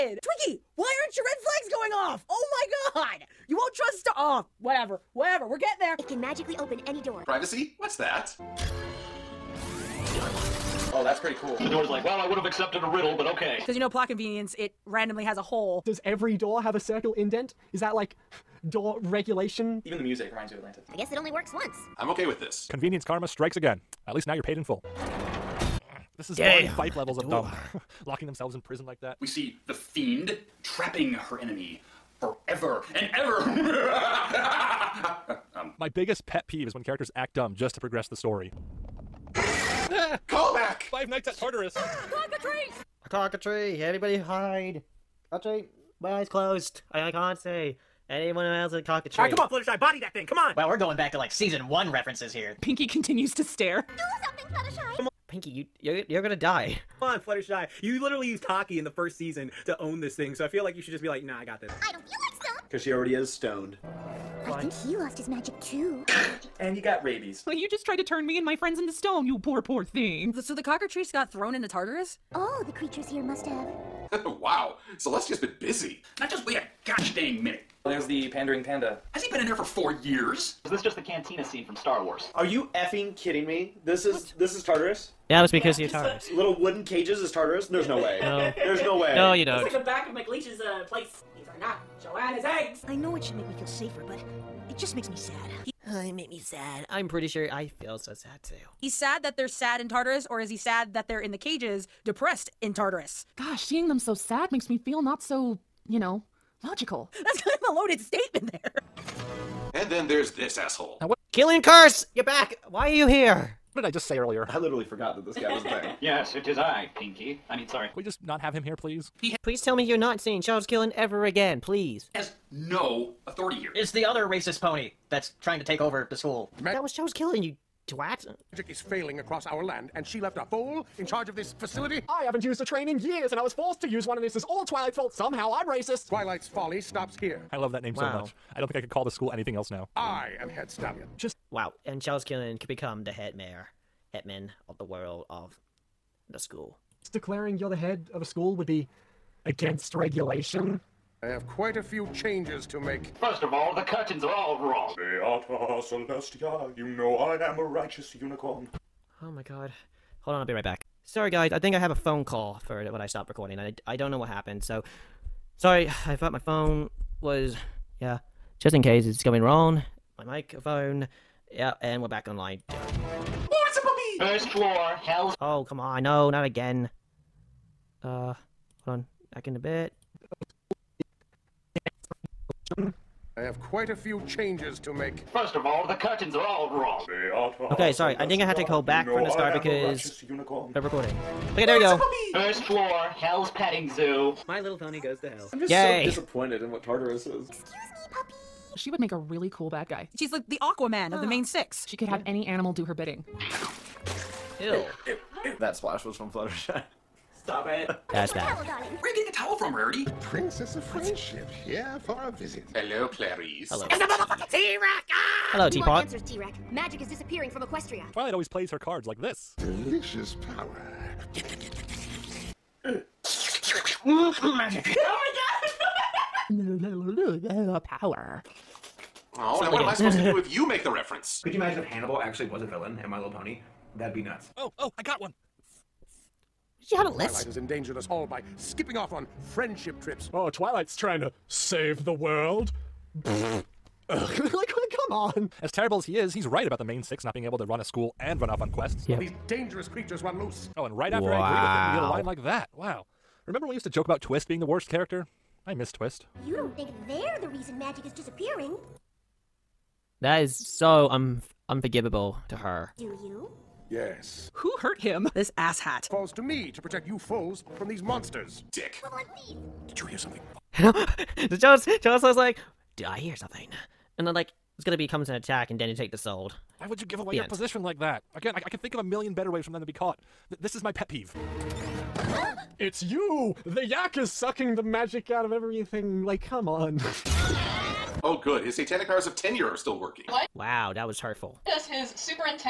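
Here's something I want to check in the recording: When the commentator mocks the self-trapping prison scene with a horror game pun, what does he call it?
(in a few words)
Five Nights at Tartarus.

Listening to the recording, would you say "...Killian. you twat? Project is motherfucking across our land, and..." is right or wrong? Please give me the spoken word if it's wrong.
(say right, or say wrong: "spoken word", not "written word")
wrong: "failing", not "motherfucking".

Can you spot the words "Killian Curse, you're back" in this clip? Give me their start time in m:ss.
1:51.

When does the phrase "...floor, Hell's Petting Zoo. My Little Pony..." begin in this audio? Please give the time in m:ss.
3:12.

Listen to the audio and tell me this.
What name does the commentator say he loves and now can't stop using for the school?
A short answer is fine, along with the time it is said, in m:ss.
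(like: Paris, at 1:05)
Twilight's folly, at 2:16.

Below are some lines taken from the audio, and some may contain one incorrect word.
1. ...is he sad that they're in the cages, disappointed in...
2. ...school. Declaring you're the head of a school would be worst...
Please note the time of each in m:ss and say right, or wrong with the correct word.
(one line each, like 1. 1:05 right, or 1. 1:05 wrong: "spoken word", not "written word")
1. 1:40 wrong: "depressed", not "disappointed"
2. 2:26 wrong: "against", not "worst".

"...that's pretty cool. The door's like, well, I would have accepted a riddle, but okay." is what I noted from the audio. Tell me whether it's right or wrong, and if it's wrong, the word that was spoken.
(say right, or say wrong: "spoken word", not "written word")
right.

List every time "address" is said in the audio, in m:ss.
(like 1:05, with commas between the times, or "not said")
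not said.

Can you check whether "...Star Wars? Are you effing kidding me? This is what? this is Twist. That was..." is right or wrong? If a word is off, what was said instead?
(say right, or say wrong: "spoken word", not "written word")
wrong: "Tartarus", not "Twist".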